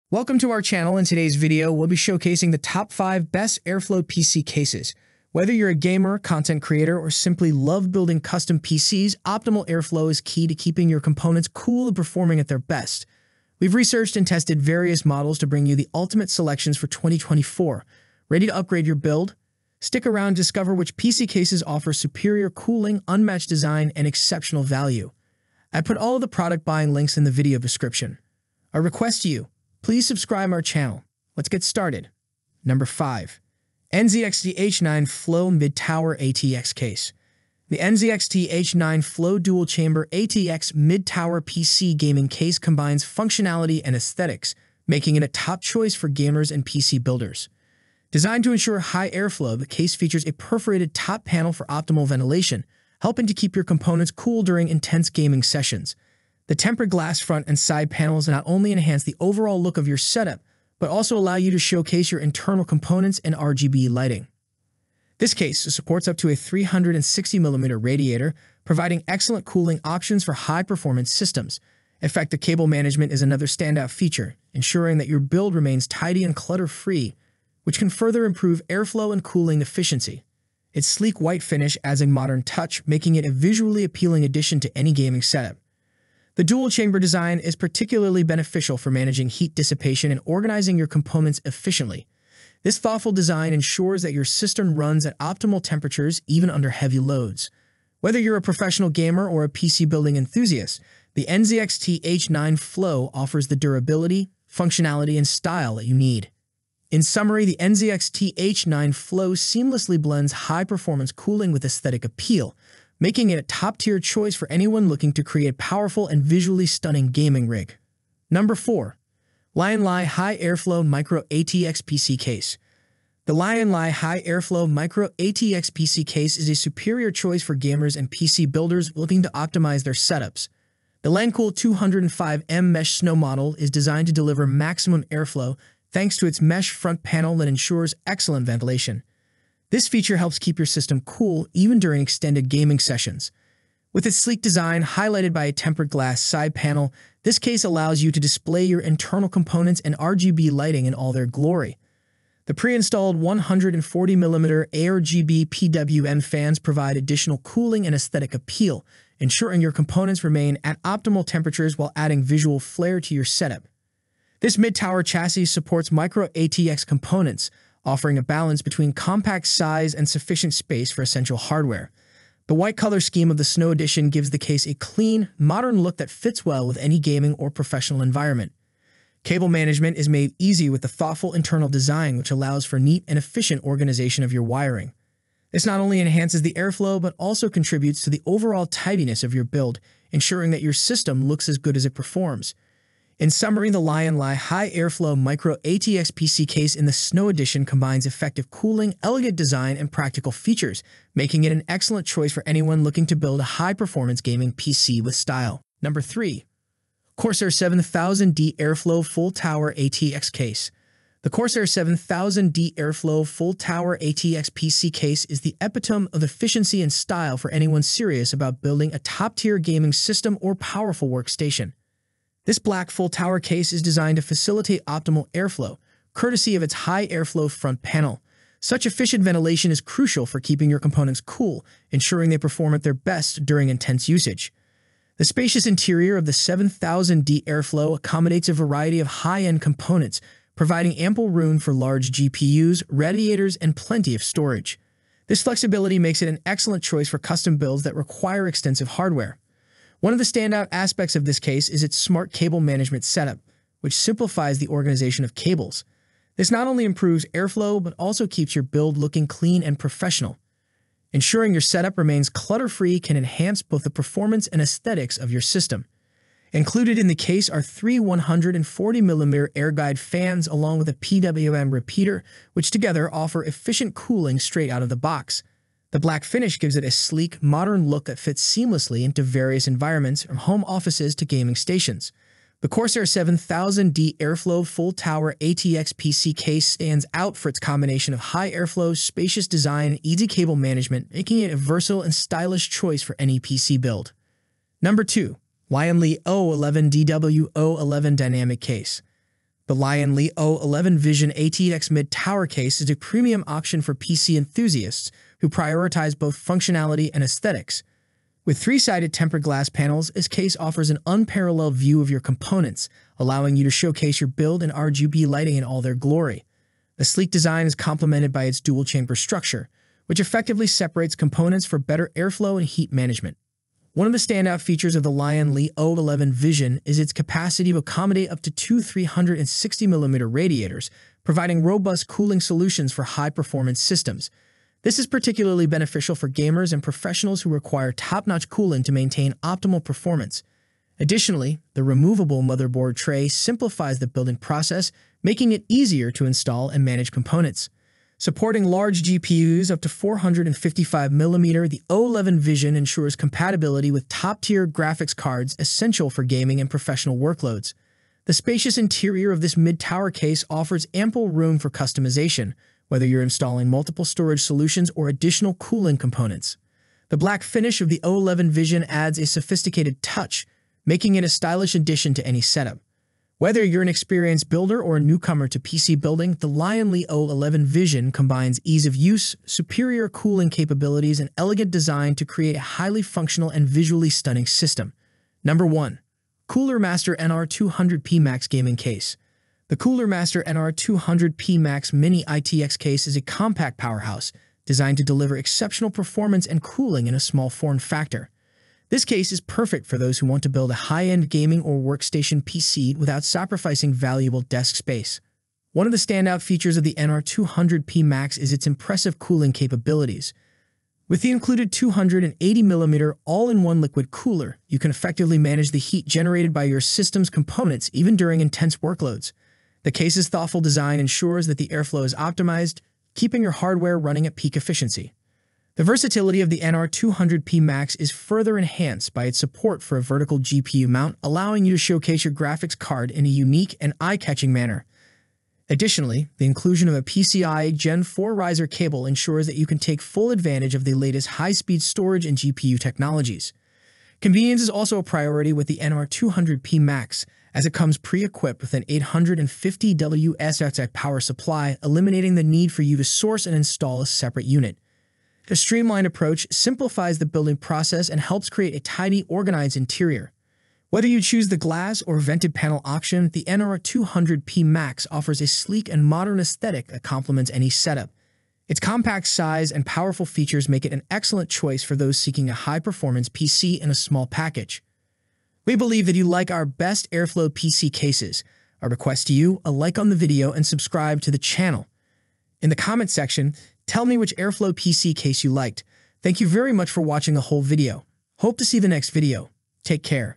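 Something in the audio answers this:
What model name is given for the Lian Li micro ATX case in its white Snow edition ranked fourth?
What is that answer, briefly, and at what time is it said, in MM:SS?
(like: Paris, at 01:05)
Lancool 205M, at 02:11.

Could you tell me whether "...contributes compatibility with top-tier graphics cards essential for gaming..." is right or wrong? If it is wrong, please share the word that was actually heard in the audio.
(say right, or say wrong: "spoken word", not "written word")
wrong: "ensures", not "contributes".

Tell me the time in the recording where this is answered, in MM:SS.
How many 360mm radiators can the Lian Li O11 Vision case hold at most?
05:28.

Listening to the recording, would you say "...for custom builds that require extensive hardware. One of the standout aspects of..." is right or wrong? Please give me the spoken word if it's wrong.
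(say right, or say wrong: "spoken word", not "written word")
right.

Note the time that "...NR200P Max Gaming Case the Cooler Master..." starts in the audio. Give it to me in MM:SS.
06:27.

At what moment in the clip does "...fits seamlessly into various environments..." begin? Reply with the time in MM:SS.
04:38.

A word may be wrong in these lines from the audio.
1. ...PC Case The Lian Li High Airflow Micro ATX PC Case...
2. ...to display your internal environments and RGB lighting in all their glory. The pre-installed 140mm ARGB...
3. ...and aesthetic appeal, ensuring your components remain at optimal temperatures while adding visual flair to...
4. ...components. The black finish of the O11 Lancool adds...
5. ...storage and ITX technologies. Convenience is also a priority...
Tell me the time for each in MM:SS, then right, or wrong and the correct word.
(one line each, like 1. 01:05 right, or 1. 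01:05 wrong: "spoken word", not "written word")
1. 02:01 right
2. 02:28 wrong: "components", not "environments"
3. 02:37 right
4. 06:05 wrong: "Vision", not "Lancool"
5. 07:21 wrong: "GPU", not "ITX".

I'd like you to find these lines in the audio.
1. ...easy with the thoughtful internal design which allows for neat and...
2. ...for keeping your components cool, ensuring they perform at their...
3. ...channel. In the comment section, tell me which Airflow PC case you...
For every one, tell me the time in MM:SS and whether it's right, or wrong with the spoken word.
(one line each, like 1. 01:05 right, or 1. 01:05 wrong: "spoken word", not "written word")
1. 03:00 right
2. 03:50 right
3. 08:01 right.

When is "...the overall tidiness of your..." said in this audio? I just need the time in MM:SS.
03:08.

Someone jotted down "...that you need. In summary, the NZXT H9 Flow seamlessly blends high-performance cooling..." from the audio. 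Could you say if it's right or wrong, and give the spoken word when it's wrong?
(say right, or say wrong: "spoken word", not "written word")
right.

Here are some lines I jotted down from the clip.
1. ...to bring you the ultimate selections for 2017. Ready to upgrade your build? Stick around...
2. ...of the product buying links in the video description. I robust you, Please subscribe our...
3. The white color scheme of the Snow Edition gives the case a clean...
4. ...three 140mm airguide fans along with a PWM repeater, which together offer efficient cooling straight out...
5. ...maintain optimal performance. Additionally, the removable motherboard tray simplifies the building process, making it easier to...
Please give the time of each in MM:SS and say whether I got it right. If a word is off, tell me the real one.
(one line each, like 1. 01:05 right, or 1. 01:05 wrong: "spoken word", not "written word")
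1. 00:15 wrong: "2024", not "2017"
2. 00:26 wrong: "request", not "robust"
3. 02:52 right
4. 04:27 right
5. 05:38 right.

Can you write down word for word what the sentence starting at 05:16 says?
The sleek design is complemented by its dual-chamber structure, which effectively separates components for better airflow and heat management.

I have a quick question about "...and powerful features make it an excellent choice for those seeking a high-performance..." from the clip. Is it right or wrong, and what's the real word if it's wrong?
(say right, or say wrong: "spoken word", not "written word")
right.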